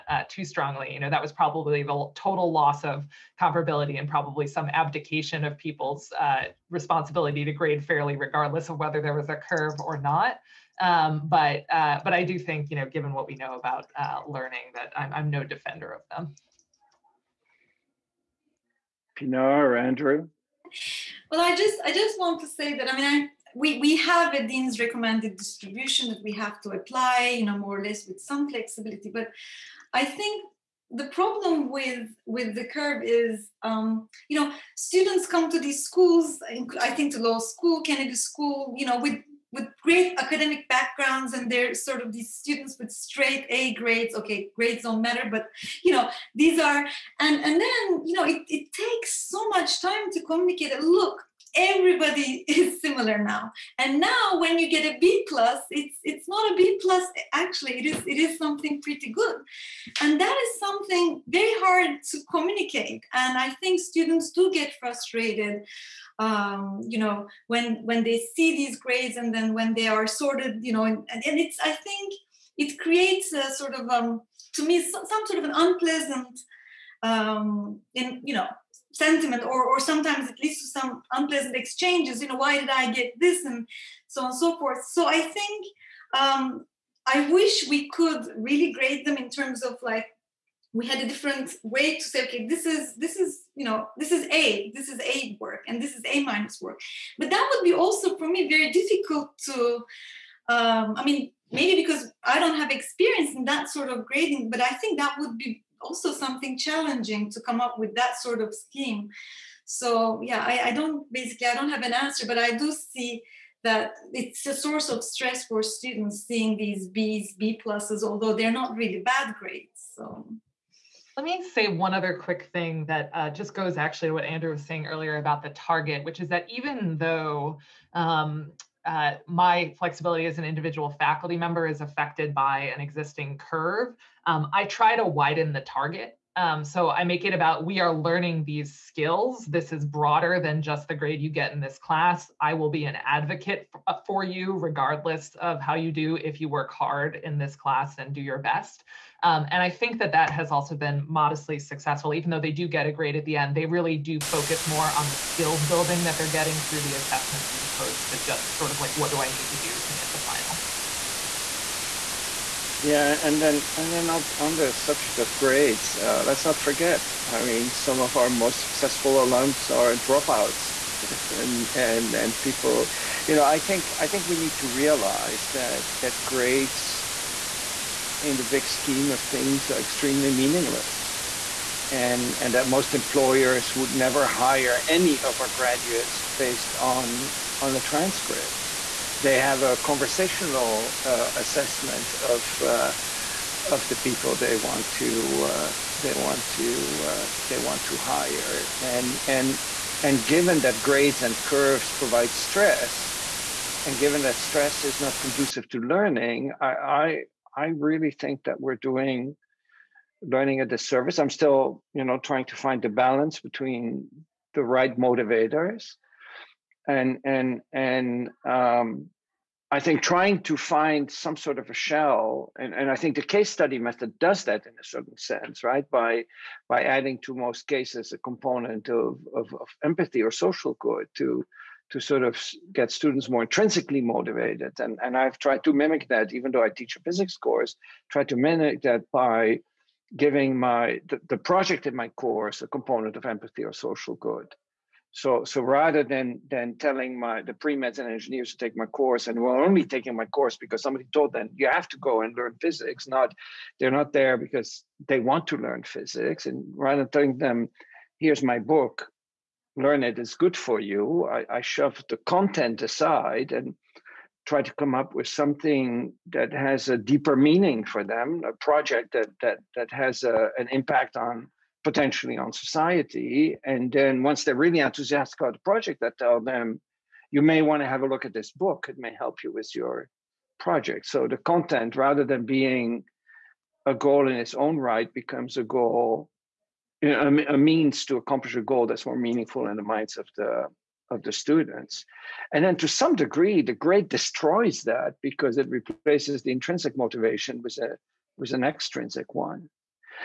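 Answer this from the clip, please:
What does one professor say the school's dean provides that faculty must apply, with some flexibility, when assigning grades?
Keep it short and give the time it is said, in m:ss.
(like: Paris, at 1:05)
recommended distribution, at 0:24.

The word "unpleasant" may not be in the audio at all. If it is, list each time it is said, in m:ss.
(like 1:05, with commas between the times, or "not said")
1:15, 1:21.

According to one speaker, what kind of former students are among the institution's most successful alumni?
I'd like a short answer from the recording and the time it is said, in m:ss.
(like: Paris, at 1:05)
dropouts, at 2:49.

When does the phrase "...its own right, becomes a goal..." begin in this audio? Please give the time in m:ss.
4:44.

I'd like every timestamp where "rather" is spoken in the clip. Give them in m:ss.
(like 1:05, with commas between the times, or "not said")
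4:05, 4:16, 4:41.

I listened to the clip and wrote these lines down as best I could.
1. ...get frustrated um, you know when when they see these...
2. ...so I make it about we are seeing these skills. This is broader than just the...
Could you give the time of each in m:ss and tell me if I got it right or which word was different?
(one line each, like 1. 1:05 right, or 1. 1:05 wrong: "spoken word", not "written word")
1. 1:04 right
2. 2:16 wrong: "learning", not "seeing".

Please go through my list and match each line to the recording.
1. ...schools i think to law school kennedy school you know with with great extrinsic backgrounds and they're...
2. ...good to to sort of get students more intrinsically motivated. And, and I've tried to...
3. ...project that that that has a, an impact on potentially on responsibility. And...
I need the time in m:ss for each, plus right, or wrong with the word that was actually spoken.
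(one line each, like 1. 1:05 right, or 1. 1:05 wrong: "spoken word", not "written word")
1. 0:35 wrong: "academic", not "extrinsic"
2. 3:50 right
3. 4:28 wrong: "society", not "responsibility".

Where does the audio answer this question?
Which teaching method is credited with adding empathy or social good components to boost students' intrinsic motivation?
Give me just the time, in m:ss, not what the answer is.
3:43.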